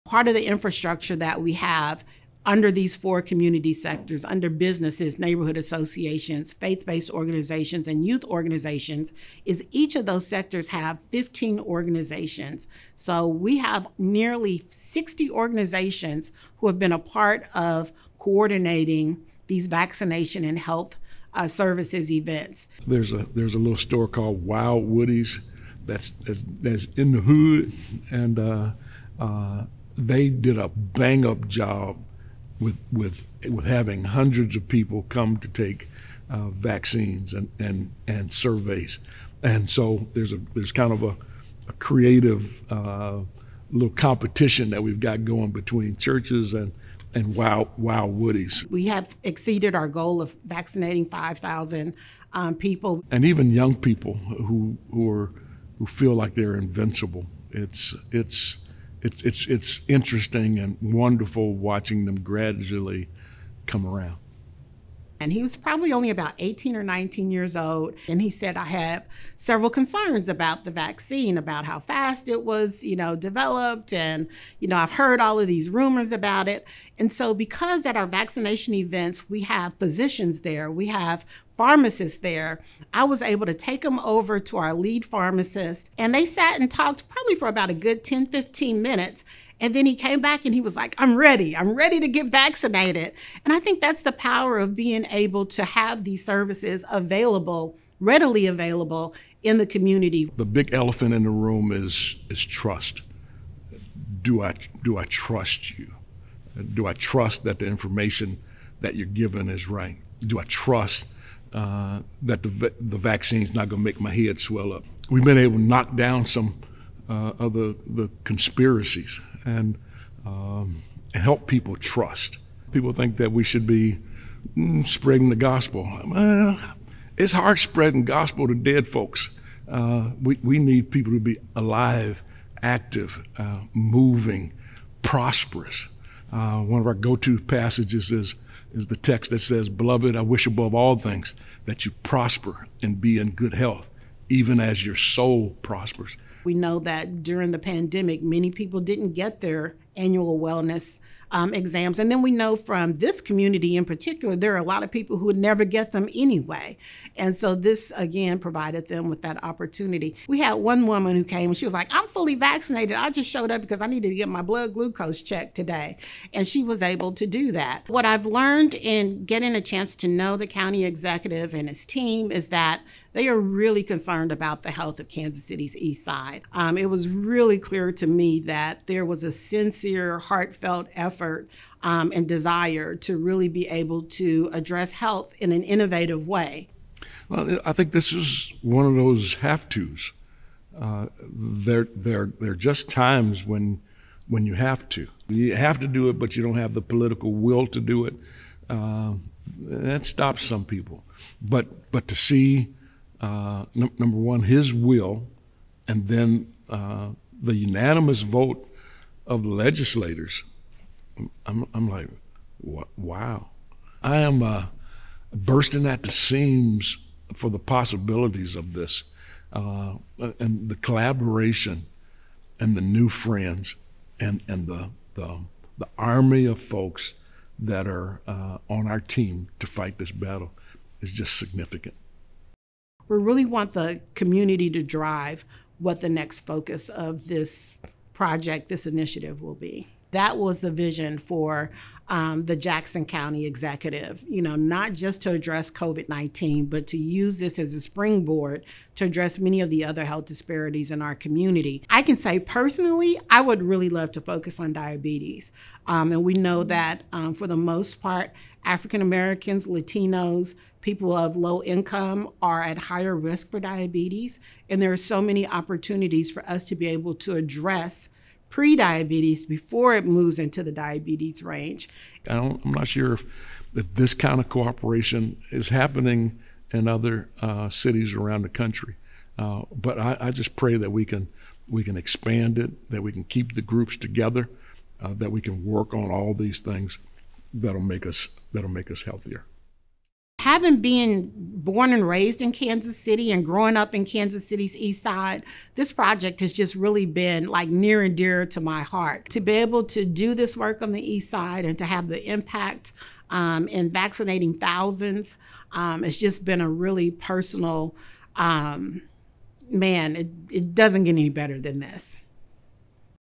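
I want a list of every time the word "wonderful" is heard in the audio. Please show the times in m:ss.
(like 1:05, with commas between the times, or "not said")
1:00.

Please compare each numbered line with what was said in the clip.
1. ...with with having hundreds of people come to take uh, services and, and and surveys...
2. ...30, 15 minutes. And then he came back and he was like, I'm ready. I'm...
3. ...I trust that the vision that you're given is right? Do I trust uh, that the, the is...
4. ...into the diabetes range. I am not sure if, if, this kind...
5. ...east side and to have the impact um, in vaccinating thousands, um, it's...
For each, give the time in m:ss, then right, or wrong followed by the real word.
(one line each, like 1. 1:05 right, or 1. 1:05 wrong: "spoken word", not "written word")
1. 0:32 wrong: "vaccines", not "services"
2. 1:28 wrong: "10", not "30"
3. 1:46 wrong: "information", not "vision"
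4. 4:30 right
5. 5:01 right.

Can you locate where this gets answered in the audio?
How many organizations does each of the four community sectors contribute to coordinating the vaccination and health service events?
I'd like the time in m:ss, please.
0:11.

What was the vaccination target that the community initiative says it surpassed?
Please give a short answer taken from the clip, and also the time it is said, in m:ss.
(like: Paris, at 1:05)
5,000, at 0:51.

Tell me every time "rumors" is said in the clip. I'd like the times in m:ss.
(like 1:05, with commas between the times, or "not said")
1:15.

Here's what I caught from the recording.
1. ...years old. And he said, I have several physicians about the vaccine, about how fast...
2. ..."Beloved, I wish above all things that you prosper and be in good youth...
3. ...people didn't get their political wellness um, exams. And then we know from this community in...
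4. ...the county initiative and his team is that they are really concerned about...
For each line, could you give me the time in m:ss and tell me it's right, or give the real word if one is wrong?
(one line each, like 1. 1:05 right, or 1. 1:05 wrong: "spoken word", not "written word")
1. 1:07 wrong: "concerns", not "physicians"
2. 2:19 wrong: "health", not "youth"
3. 2:28 wrong: "annual", not "political"
4. 2:50 wrong: "executive", not "initiative".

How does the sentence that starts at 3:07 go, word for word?
Well, I think this is one of those have tos.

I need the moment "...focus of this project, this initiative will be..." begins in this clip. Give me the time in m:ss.
3:56.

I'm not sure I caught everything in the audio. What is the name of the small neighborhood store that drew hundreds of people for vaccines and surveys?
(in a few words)
Wild Woody's.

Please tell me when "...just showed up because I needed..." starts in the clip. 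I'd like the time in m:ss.
2:43.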